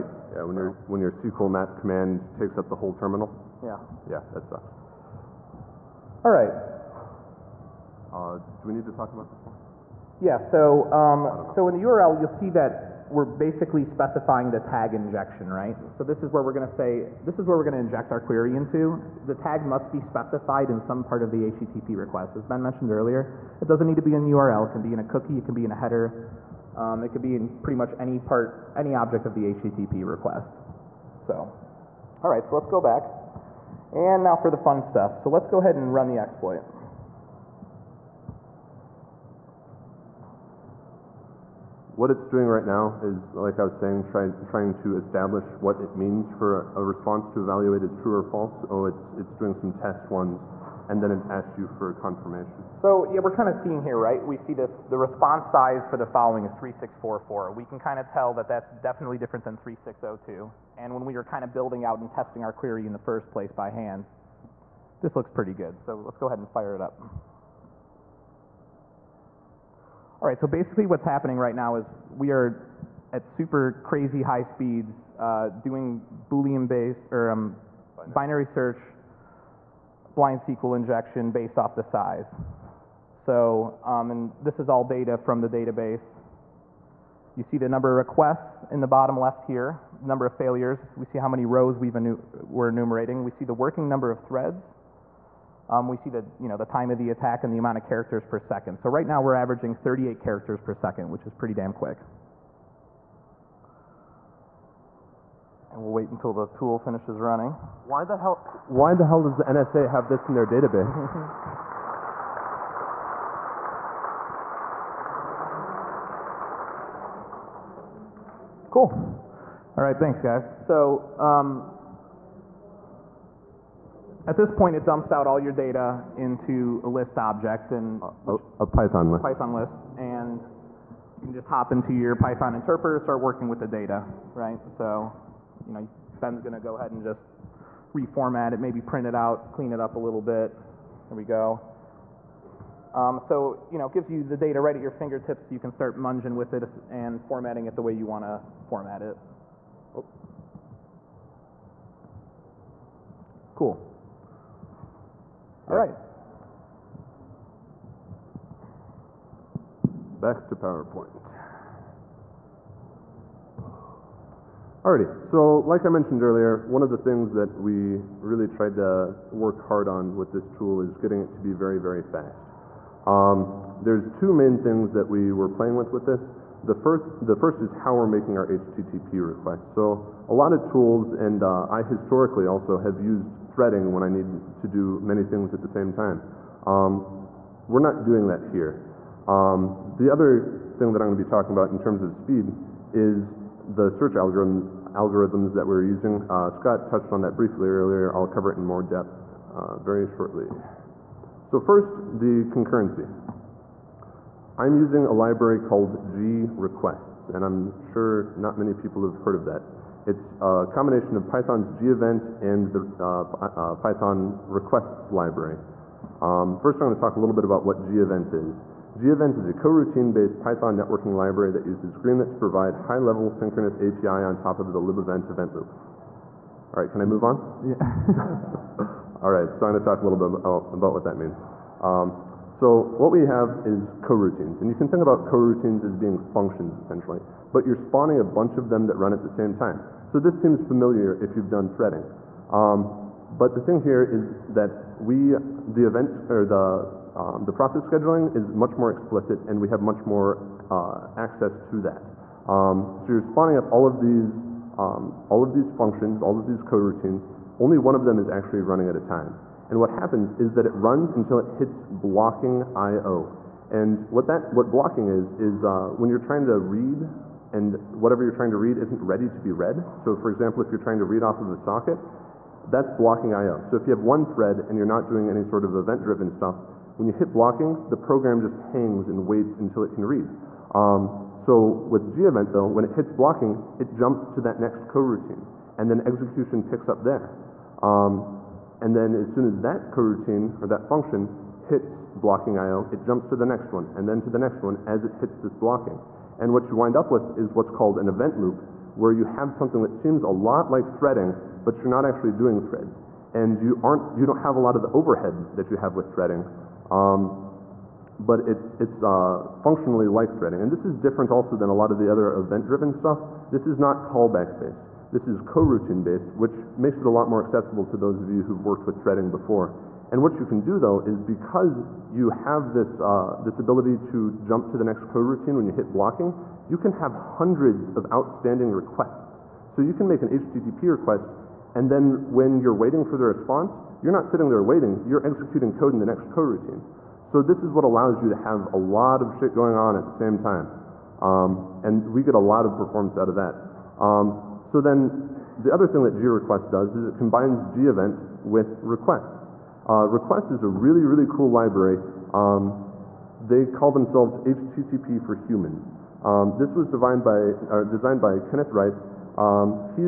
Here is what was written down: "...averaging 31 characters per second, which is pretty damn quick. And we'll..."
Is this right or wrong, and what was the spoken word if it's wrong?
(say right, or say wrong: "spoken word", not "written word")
wrong: "38", not "31".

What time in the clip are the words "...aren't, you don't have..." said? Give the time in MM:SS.
05:03.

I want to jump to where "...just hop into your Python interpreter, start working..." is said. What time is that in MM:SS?
02:11.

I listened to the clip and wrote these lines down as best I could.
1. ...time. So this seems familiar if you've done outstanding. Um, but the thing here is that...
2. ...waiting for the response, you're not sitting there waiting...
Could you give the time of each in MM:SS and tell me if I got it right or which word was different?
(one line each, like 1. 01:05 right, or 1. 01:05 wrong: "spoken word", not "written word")
1. 03:59 wrong: "threading", not "outstanding"
2. 05:32 right.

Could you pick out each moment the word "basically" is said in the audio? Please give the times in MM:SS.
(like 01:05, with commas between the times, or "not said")
00:13, 01:10.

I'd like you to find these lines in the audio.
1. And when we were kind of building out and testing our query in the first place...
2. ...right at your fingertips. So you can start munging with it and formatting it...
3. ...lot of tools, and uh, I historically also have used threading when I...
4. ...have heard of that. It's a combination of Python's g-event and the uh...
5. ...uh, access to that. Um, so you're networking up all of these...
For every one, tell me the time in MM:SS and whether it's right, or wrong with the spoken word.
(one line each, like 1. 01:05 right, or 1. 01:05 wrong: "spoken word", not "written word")
1. 01:00 right
2. 02:24 right
3. 03:00 right
4. 03:29 right
5. 04:10 wrong: "spawning", not "networking".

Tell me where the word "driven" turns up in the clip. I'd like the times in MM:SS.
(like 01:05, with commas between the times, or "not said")
04:35, 05:12.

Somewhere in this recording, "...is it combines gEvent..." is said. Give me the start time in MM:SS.
05:46.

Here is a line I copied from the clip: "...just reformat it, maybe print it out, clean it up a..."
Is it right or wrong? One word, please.
right.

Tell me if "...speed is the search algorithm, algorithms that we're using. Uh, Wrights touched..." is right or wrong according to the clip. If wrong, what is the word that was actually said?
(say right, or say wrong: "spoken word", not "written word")
wrong: "Scott", not "Wrights".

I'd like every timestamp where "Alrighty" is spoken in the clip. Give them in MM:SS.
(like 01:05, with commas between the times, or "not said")
02:44.